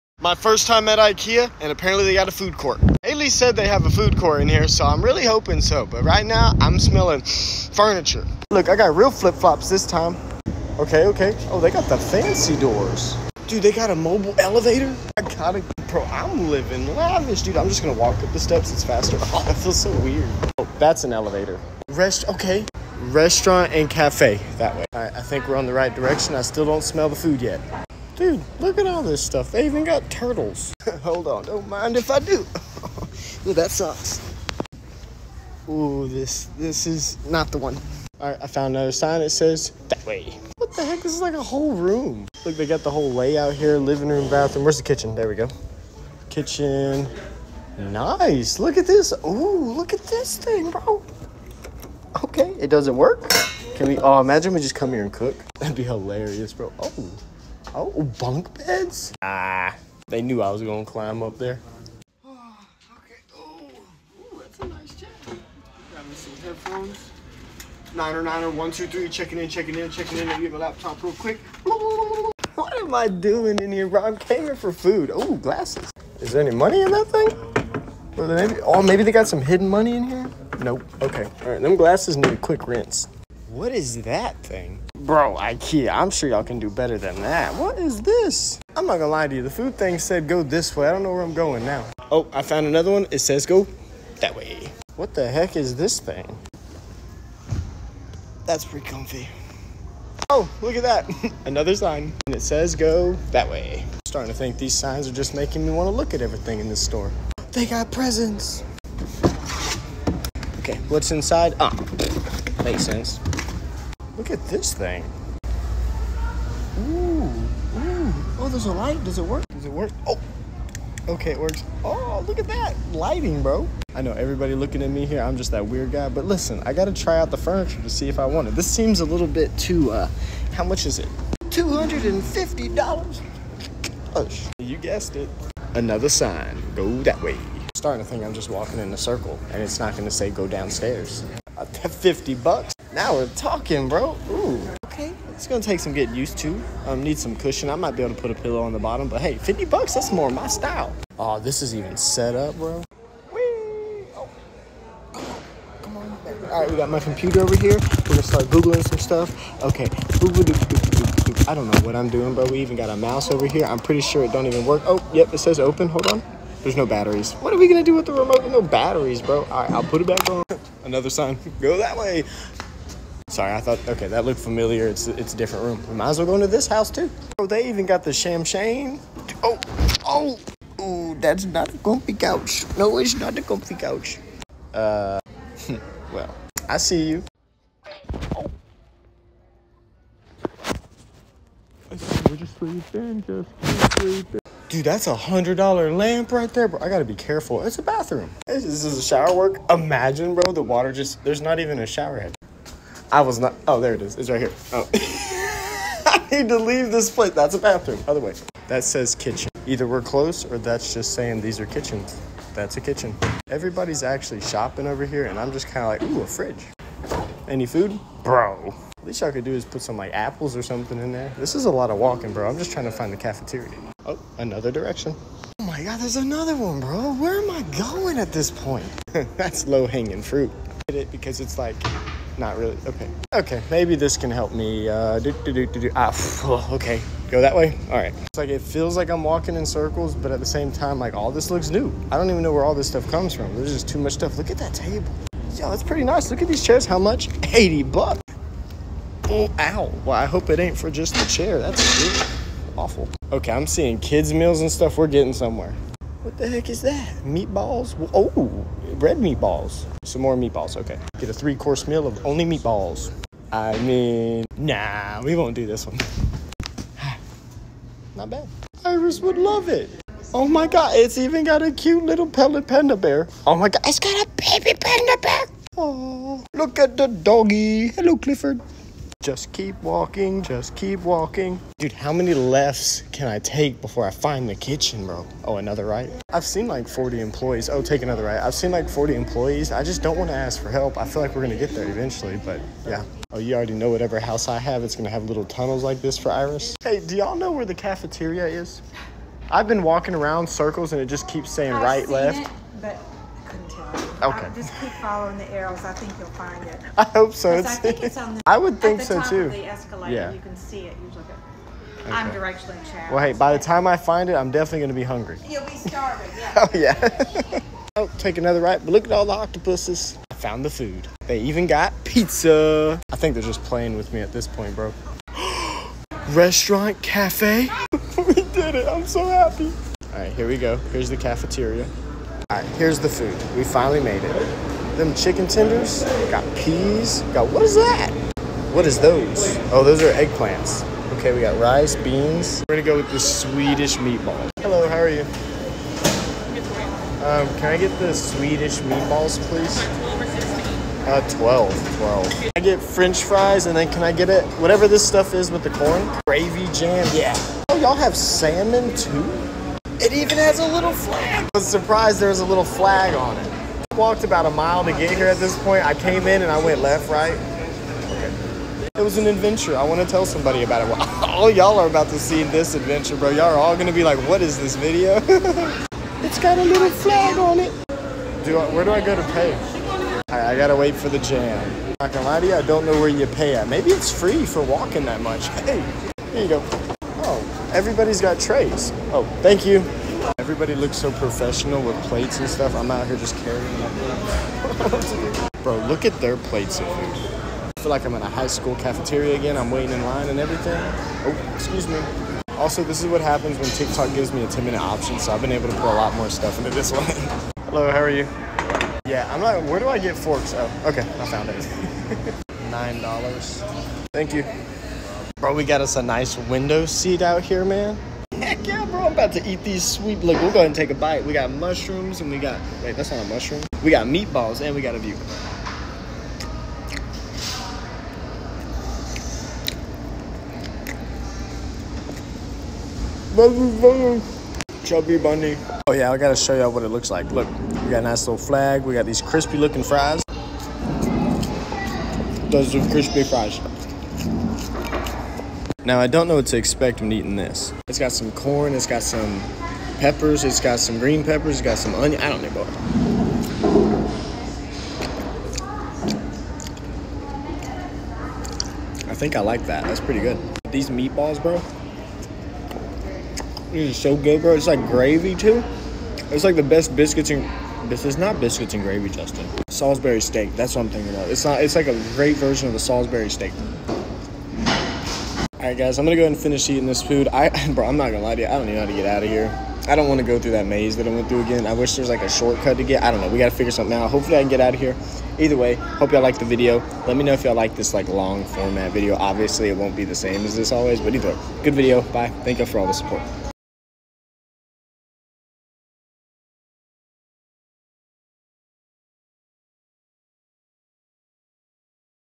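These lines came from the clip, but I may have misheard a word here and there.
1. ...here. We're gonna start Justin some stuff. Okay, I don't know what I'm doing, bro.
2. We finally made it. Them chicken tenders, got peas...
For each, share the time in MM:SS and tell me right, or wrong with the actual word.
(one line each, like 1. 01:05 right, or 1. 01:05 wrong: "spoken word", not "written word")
1. 02:37 wrong: "Googling", not "Justin"
2. 05:33 right.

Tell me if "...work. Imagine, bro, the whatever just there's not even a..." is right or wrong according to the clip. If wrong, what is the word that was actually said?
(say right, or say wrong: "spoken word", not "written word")
wrong: "water", not "whatever".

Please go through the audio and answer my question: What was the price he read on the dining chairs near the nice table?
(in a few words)
80 bucks.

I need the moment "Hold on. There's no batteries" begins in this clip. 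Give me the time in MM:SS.
02:45.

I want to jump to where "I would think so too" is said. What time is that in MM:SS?
05:08.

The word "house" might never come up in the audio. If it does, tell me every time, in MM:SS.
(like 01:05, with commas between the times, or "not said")
02:56, 04:54.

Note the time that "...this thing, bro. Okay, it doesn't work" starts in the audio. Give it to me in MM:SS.
00:50.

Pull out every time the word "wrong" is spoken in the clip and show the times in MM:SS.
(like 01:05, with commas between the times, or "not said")
not said.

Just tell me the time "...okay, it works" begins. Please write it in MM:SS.
02:01.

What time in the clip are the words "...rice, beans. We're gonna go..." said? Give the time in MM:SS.
05:41.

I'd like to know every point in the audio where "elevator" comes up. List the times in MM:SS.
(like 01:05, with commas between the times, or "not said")
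00:14, 00:21.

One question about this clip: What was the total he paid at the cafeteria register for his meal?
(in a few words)
$9.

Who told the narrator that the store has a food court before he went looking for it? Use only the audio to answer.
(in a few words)
Haley.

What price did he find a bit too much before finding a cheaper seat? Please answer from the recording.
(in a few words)
$250.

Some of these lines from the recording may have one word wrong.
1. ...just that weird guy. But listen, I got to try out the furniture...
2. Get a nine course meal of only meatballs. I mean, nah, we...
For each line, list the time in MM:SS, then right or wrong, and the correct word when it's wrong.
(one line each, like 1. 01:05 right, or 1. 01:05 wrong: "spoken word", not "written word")
1. 02:05 right
2. 04:21 wrong: "three", not "nine".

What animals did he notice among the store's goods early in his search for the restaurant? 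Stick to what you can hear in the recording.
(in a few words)
Turtles.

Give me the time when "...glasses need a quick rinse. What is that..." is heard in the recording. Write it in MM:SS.
01:21.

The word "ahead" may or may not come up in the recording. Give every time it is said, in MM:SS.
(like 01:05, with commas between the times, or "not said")
07:00, 07:56.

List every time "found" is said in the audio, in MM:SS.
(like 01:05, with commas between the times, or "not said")
00:38, 01:32, 05:20, 06:51.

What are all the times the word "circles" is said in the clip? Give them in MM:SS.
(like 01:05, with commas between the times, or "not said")
02:18, 03:59, 05:00.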